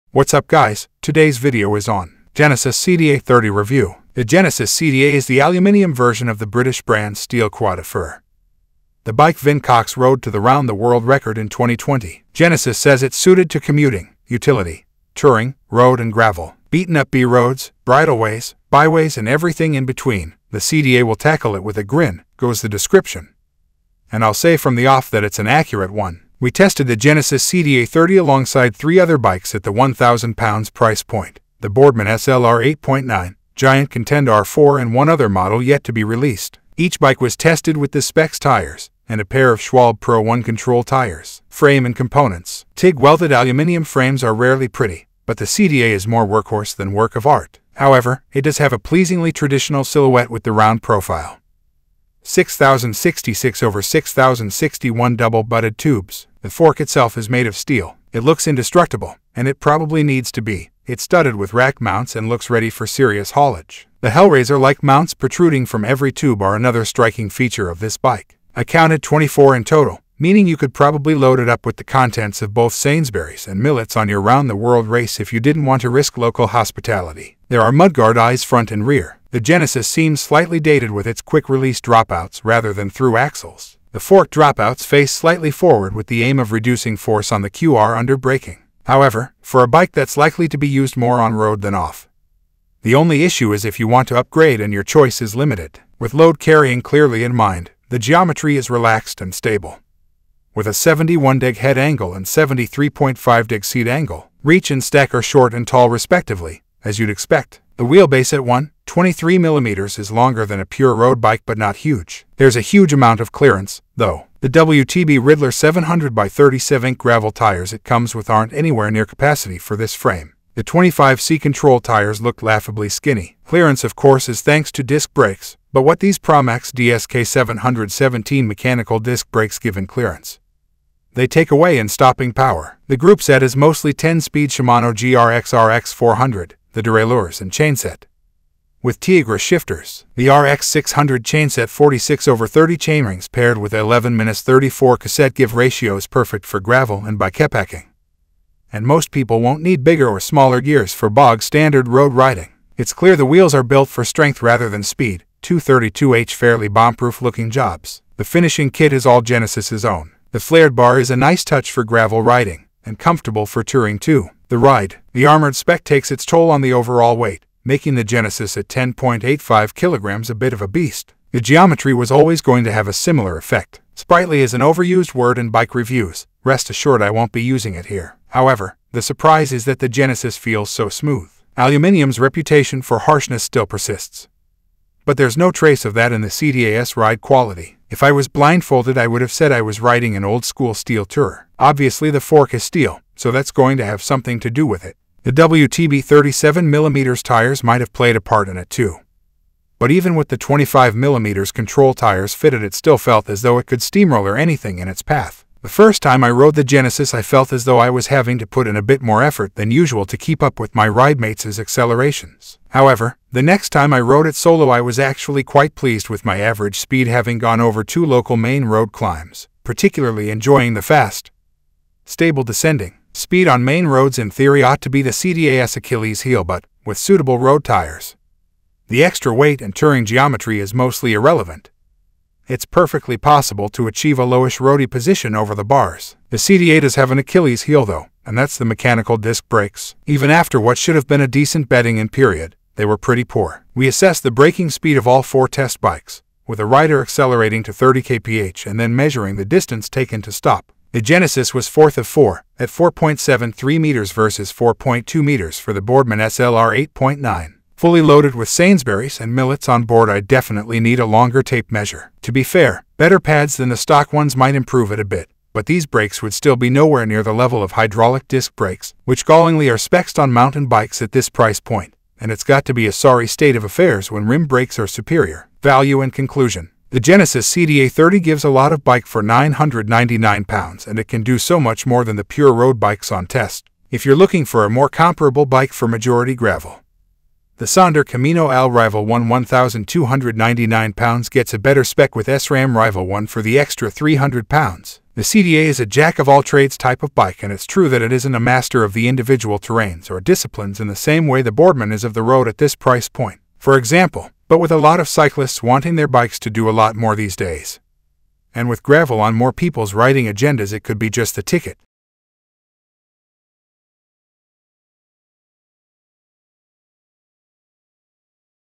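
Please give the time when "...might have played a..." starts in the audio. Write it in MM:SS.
03:17.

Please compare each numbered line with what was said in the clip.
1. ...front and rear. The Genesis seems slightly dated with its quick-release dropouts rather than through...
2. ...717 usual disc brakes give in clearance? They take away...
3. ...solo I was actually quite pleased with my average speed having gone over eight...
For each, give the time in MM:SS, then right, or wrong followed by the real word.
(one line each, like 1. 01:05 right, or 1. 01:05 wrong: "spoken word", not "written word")
1. 01:18 right
2. 02:07 wrong: "mechanical", not "usual"
3. 03:34 wrong: "two", not "eight".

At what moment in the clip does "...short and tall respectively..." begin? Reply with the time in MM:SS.
01:45.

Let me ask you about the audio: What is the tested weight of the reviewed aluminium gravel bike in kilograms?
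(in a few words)
10.85 kg.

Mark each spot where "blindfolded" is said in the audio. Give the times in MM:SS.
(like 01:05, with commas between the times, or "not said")
03:08.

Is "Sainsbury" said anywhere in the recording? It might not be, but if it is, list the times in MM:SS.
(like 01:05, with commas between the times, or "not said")
01:12, 04:18.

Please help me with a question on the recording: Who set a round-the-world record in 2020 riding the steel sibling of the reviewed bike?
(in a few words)
Vin Cox.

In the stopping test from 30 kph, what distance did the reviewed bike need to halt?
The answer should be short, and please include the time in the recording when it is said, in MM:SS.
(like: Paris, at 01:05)
4.73 meters, at 04:12.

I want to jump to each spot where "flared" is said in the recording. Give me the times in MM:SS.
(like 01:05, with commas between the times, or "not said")
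02:40.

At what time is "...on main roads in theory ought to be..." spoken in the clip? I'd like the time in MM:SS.
03:43.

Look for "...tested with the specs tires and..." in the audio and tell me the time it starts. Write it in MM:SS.
00:37.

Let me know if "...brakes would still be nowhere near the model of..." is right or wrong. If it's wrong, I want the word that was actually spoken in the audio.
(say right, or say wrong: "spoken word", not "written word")
wrong: "level", not "model".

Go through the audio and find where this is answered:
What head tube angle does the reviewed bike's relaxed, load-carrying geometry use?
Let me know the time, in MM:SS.
01:40.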